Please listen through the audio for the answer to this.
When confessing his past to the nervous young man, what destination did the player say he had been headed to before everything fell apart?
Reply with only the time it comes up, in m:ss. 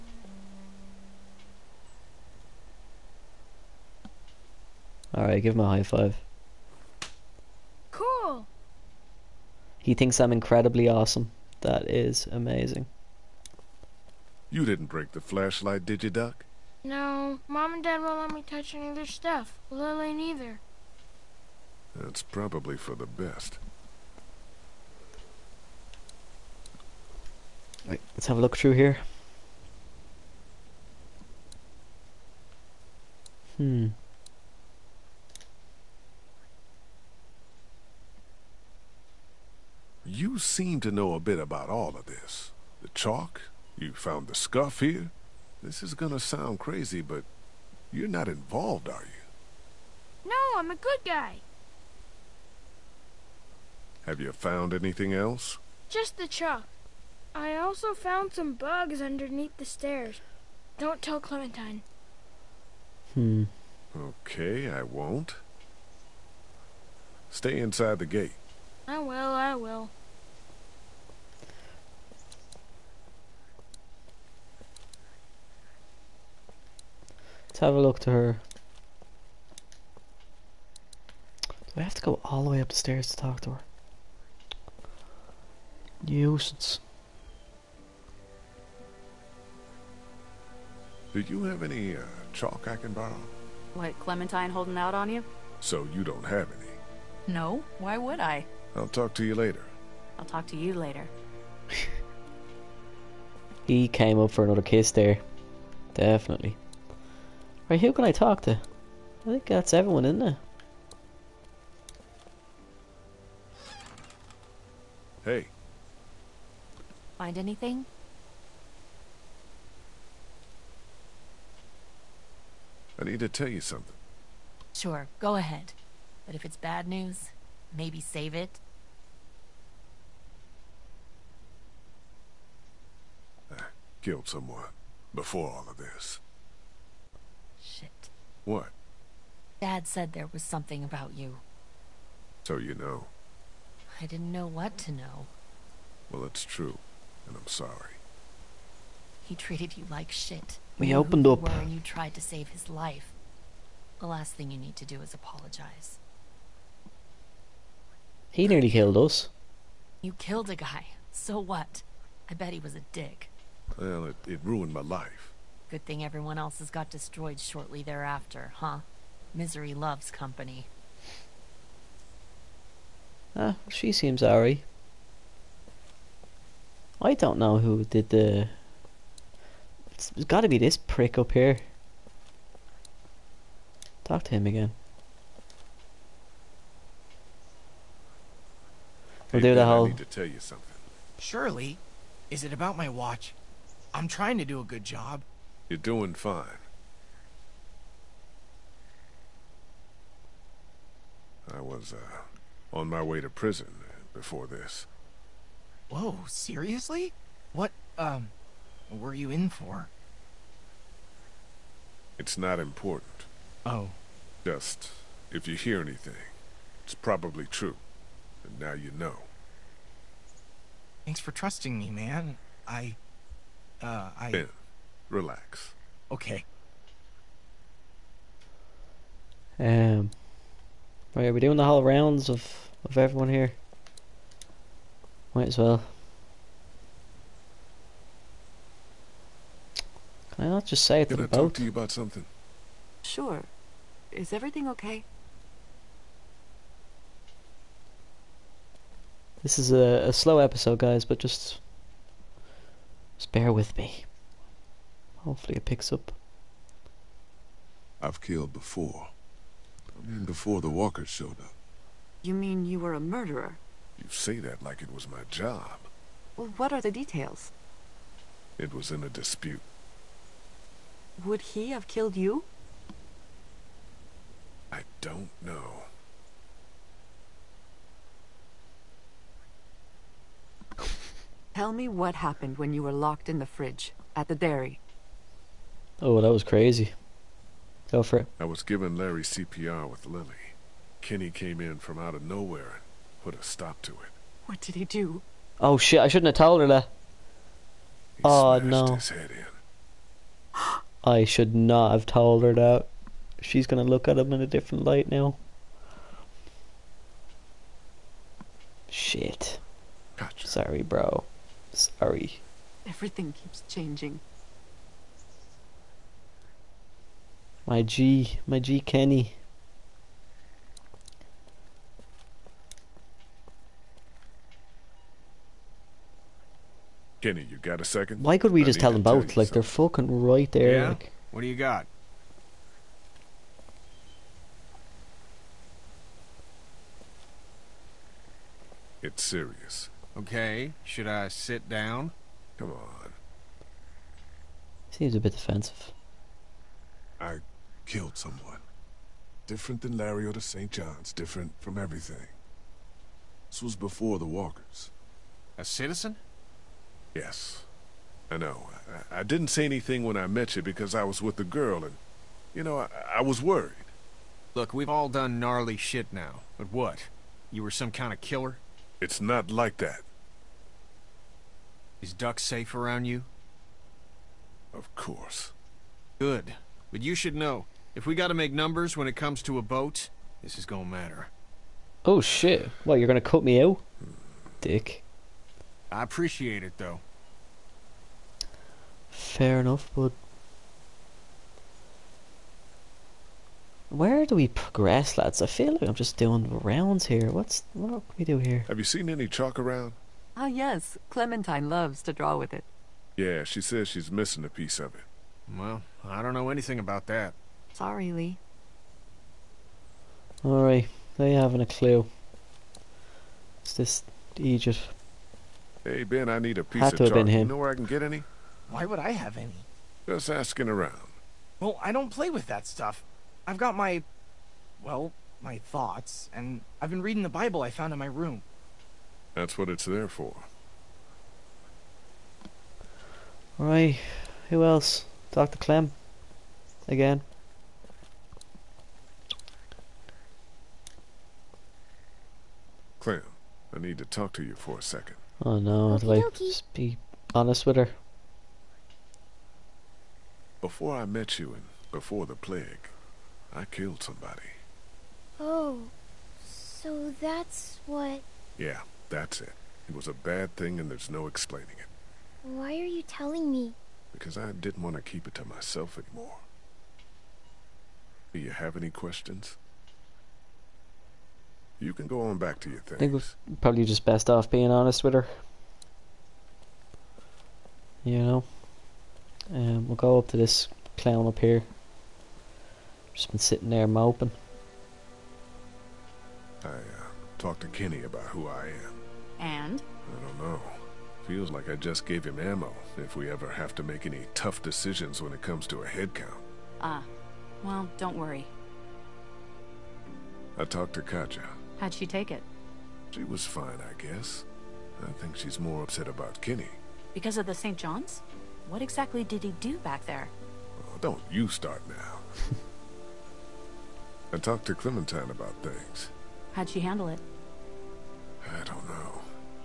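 3:23.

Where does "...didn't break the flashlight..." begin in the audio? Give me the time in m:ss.
0:14.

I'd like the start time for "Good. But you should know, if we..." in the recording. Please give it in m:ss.
6:16.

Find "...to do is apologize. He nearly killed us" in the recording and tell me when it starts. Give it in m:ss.
2:34.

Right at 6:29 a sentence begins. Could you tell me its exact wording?
Fair enough, but where do we progress, lads?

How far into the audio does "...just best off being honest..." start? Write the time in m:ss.
7:53.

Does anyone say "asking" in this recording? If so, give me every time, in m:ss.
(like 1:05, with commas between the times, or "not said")
7:00.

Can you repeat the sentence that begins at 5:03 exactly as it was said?
She's gonna look at him in a different light now.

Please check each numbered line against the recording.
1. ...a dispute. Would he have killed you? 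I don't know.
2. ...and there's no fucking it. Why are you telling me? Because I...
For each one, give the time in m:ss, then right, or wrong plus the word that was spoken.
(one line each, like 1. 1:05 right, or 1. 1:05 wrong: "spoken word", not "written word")
1. 4:29 right
2. 7:40 wrong: "explaining", not "fucking".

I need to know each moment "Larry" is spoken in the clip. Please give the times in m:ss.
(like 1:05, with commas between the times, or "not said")
4:48, 5:49.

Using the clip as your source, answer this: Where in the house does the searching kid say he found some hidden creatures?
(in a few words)
Underneath the stairs.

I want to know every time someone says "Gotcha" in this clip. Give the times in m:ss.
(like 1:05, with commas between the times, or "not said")
5:10.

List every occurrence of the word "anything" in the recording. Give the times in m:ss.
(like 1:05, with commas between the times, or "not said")
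0:54, 1:57, 3:35, 5:59, 6:46.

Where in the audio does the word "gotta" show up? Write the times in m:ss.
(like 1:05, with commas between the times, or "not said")
3:00, 6:18.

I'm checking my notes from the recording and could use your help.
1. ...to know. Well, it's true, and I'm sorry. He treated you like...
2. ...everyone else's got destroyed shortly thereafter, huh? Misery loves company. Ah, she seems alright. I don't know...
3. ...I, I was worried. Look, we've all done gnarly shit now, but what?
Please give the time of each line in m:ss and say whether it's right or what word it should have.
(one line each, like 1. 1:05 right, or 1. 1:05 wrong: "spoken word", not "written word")
1. 2:24 right
2. 2:46 right
3. 6:02 right.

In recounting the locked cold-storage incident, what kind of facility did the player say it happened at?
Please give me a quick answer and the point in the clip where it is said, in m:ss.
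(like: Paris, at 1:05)
Dairy, at 4:44.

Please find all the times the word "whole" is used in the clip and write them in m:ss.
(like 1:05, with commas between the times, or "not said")
3:09, 3:51.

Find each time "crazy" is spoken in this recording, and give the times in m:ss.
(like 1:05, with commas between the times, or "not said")
0:46, 4:46.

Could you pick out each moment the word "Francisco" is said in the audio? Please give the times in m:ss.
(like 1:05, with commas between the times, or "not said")
not said.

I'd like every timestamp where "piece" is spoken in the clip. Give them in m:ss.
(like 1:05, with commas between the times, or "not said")
6:44, 6:56.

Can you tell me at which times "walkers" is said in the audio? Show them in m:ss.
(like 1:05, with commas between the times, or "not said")
4:20, 5:54.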